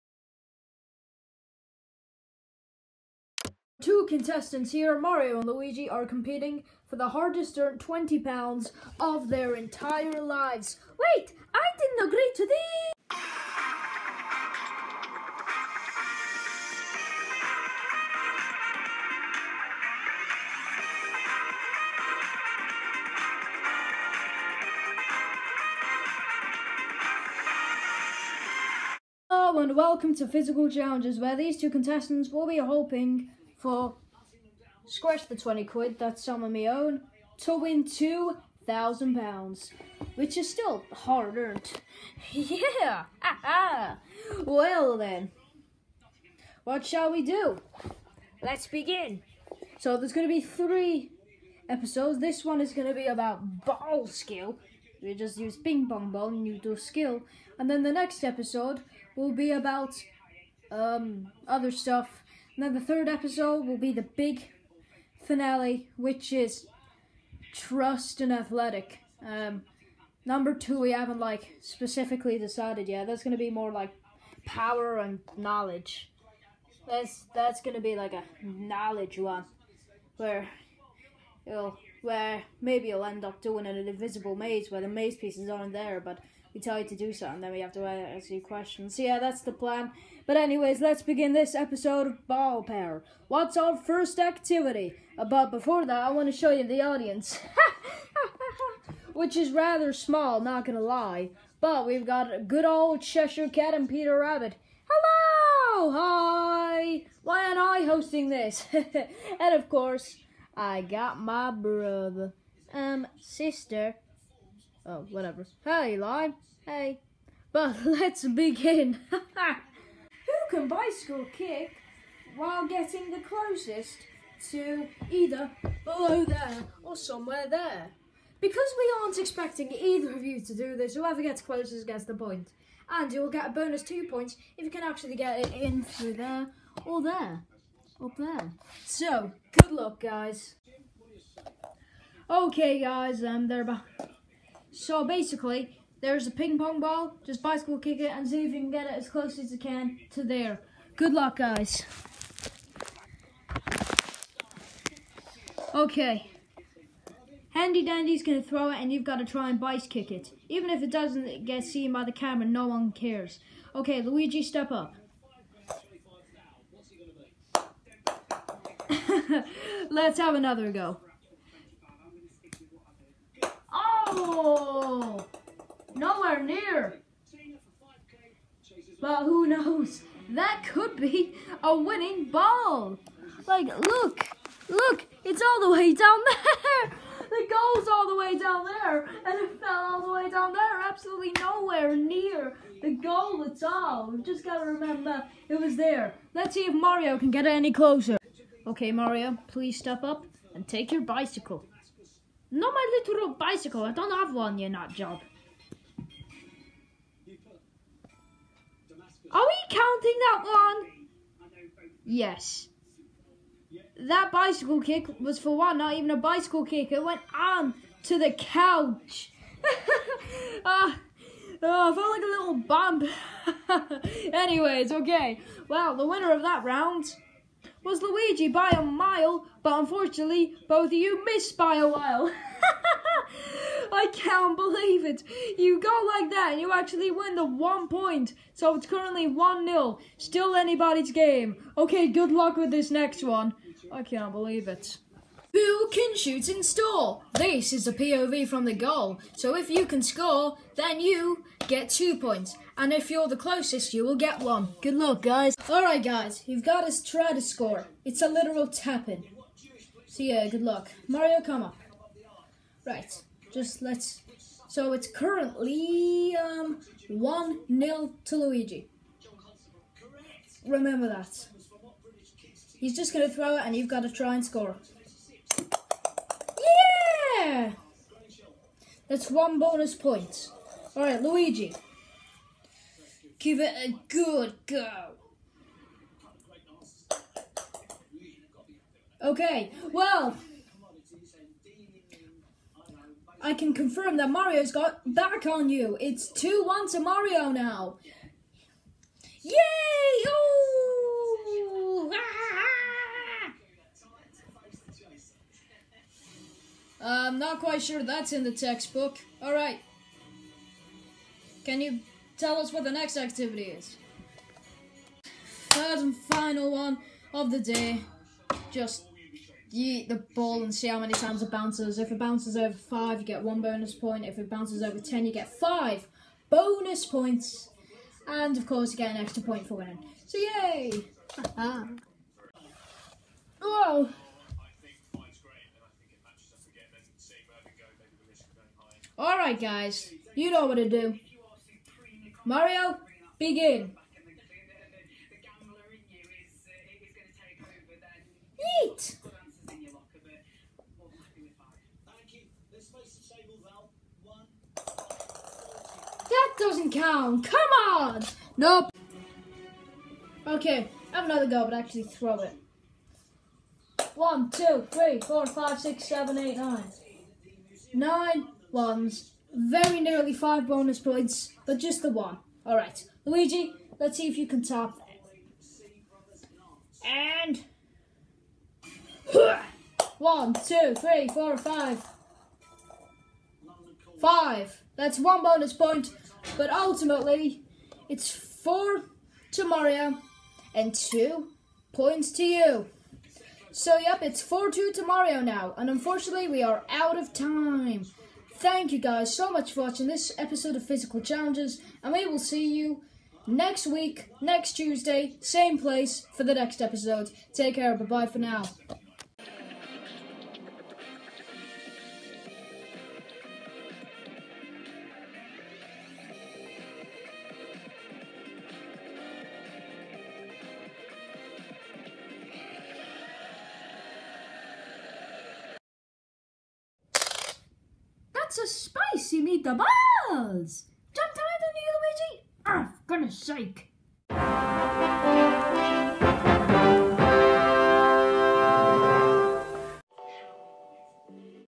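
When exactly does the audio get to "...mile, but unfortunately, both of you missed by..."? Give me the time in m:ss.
3:48.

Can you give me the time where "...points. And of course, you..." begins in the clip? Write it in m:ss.
5:27.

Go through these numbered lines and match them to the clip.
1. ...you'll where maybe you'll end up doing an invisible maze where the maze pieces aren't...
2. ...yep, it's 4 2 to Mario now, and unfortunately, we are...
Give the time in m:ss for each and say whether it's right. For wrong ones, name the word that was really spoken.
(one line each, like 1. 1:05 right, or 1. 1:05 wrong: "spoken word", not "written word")
1. 1:21 right
2. 6:33 right.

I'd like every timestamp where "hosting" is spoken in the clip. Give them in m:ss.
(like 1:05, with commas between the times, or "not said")
1:47.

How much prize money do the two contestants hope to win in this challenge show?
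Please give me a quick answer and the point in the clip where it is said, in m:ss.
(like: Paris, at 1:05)
£2,000, at 0:37.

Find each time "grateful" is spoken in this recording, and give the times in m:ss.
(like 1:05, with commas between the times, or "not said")
not said.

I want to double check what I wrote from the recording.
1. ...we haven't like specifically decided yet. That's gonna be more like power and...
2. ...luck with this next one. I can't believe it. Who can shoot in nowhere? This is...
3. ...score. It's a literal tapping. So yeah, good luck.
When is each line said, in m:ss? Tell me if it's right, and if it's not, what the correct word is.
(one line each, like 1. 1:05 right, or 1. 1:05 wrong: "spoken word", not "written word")
1. 1:10 right
2. 4:02 wrong: "store", not "nowhere"
3. 4:17 right.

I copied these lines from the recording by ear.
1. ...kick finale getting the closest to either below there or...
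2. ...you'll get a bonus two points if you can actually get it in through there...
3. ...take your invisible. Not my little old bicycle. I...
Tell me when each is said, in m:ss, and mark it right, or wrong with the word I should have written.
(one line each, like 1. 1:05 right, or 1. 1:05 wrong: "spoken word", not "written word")
1. 2:01 wrong: "while", not "finale"
2. 2:13 right
3. 3:20 wrong: "bicycle", not "invisible".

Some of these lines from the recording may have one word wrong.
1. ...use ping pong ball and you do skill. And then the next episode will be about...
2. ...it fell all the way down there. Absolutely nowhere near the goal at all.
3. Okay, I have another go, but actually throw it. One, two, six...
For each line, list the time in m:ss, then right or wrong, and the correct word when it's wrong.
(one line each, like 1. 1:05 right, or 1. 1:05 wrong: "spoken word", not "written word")
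1. 0:55 right
2. 3:09 right
3. 6:00 wrong: "three", not "six".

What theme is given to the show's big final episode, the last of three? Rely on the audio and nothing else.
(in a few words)
Trust and Athletic.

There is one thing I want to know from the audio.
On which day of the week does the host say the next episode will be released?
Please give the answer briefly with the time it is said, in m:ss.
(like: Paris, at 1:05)
Tuesday, at 6:44.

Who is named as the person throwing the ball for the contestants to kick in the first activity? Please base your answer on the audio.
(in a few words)
Handy Dandy.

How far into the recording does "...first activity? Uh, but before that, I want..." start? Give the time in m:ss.
1:33.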